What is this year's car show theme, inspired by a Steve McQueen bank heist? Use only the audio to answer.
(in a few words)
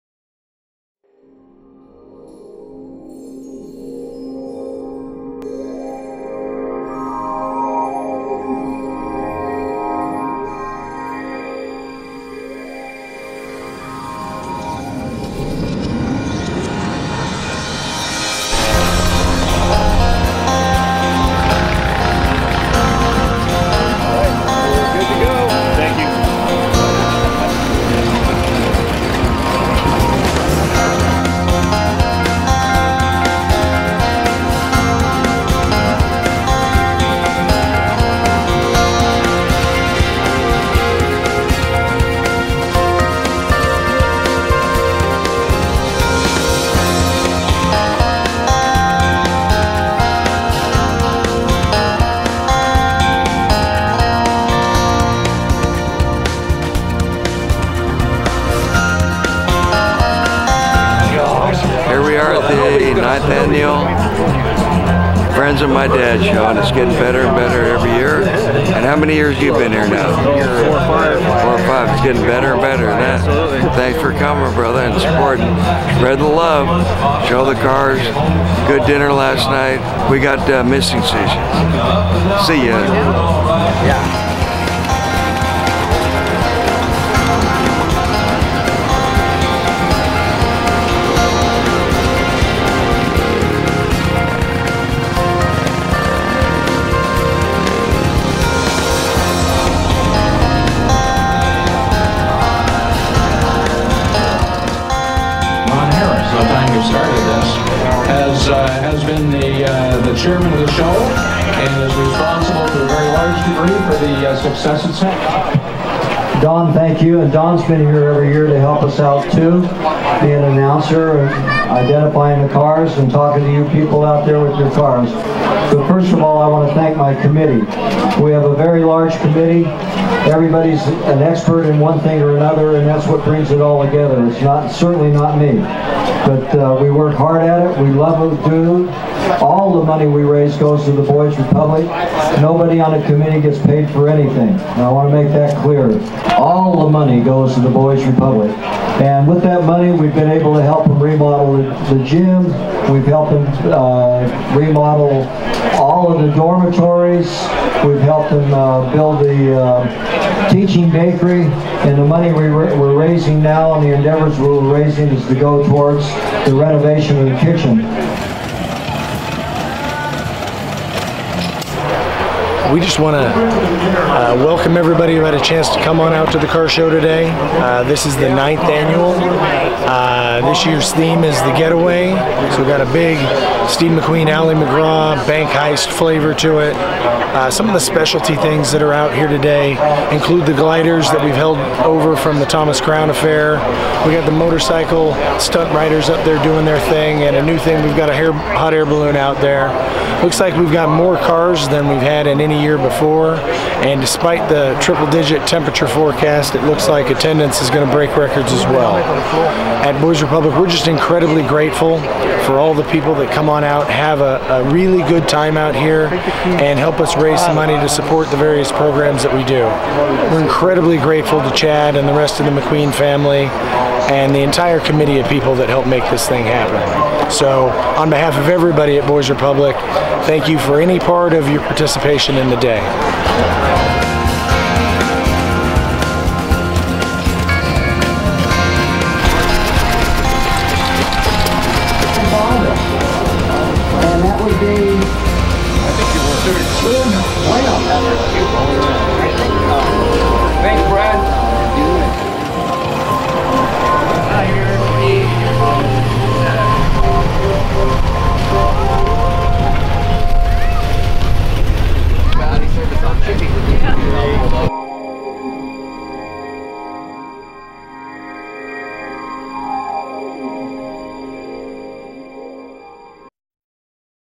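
The Getaway.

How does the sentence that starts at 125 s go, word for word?
But first of all, I want to thank my committee.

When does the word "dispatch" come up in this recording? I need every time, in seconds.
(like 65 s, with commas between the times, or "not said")
not said.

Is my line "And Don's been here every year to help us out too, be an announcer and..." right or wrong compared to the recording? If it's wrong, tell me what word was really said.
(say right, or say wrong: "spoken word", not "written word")
right.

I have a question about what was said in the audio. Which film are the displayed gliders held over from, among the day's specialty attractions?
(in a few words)
The Thomas Crown Affair.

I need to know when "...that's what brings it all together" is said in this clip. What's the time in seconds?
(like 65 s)
132 s.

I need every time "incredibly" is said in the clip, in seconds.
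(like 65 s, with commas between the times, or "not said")
210 s, 220 s.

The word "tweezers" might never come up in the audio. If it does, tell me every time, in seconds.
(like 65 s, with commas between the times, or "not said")
not said.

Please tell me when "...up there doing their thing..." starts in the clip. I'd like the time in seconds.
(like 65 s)
196 s.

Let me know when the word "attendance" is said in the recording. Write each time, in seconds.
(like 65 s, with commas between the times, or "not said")
207 s.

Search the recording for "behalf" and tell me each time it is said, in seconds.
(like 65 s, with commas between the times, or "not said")
228 s.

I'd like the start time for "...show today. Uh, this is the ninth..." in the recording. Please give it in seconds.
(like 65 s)
176 s.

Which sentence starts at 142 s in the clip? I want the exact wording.
Nobody on the committee gets paid for anything.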